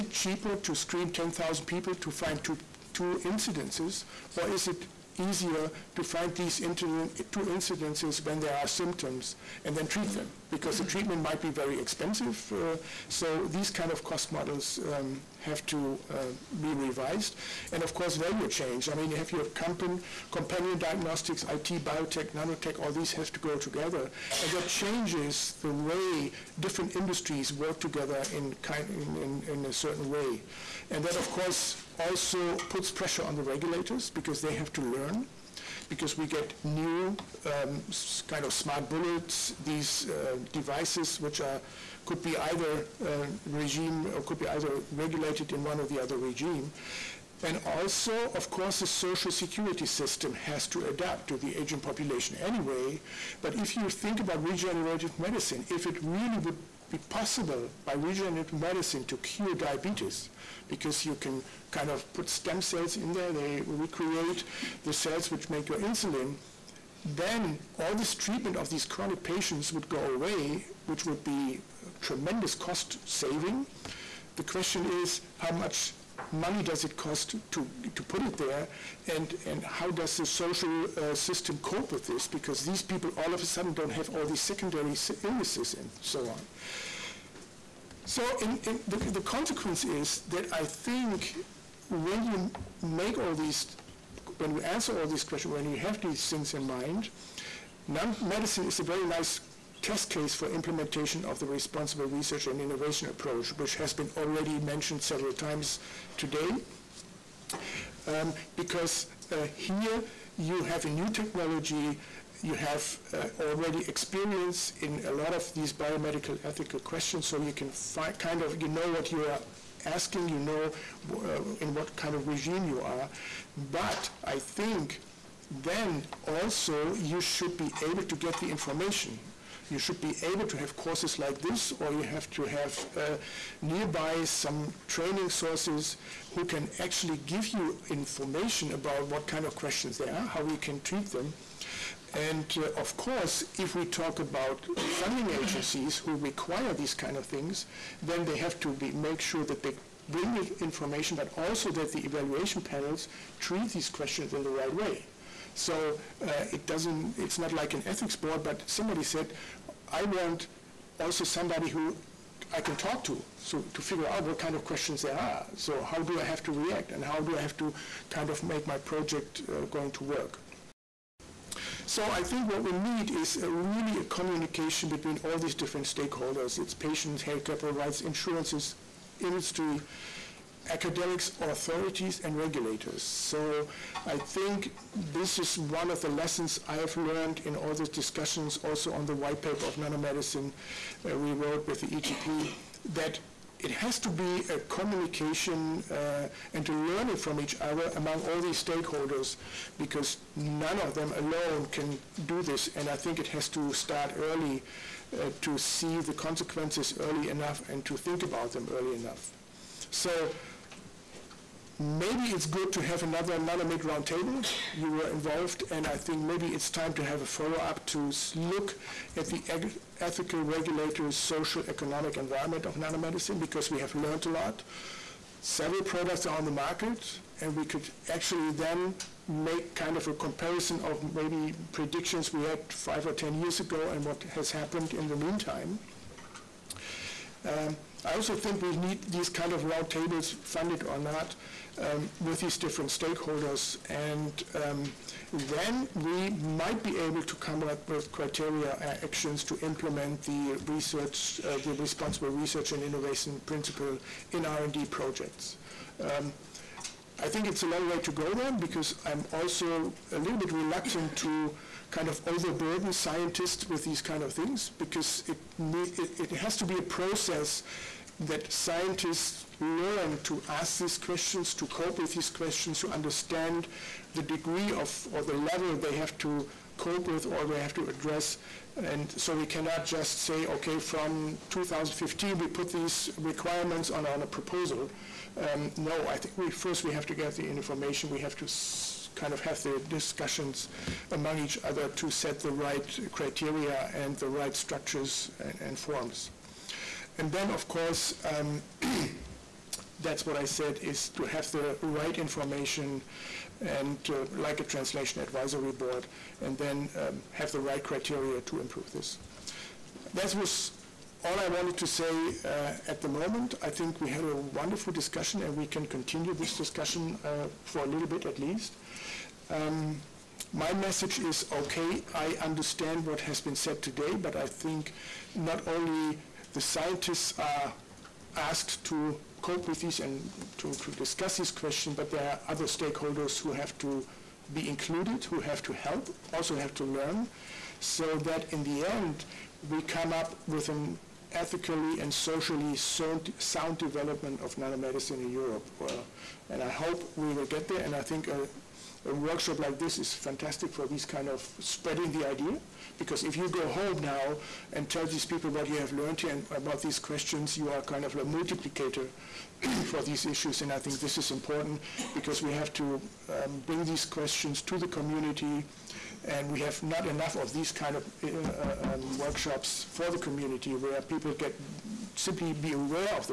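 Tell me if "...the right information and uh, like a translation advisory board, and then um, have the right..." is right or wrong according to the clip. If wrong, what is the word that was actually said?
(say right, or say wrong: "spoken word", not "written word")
right.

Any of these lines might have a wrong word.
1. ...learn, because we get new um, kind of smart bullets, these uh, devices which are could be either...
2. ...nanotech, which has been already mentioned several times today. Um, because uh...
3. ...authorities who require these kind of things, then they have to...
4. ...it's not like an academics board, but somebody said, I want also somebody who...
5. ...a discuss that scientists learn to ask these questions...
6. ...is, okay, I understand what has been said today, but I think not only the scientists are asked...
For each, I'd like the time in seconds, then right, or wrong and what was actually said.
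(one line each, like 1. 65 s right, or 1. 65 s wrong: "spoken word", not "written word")
1. 34 s right
2. 103 s wrong: "approach", not "nanotech"
3. 145 s wrong: "agencies", not "authorities"
4. 157 s wrong: "ethics", not "academics"
5. 266 s wrong: "process", not "discuss"
6. 321 s right.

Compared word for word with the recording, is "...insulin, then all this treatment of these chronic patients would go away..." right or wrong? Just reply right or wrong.
right.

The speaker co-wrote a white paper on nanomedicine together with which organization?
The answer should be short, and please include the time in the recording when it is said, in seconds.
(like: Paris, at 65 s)
ETP, at 191 s.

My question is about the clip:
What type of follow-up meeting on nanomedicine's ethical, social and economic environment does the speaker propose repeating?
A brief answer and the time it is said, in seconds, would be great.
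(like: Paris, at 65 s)
NanoMed roundtable, at 213 s.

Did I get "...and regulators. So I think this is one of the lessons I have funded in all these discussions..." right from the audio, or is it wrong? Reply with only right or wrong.
wrong.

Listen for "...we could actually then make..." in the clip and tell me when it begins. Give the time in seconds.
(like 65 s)
227 s.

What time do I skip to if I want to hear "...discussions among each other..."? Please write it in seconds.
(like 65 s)
289 s.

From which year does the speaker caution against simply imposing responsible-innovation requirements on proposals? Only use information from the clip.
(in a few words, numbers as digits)
2015.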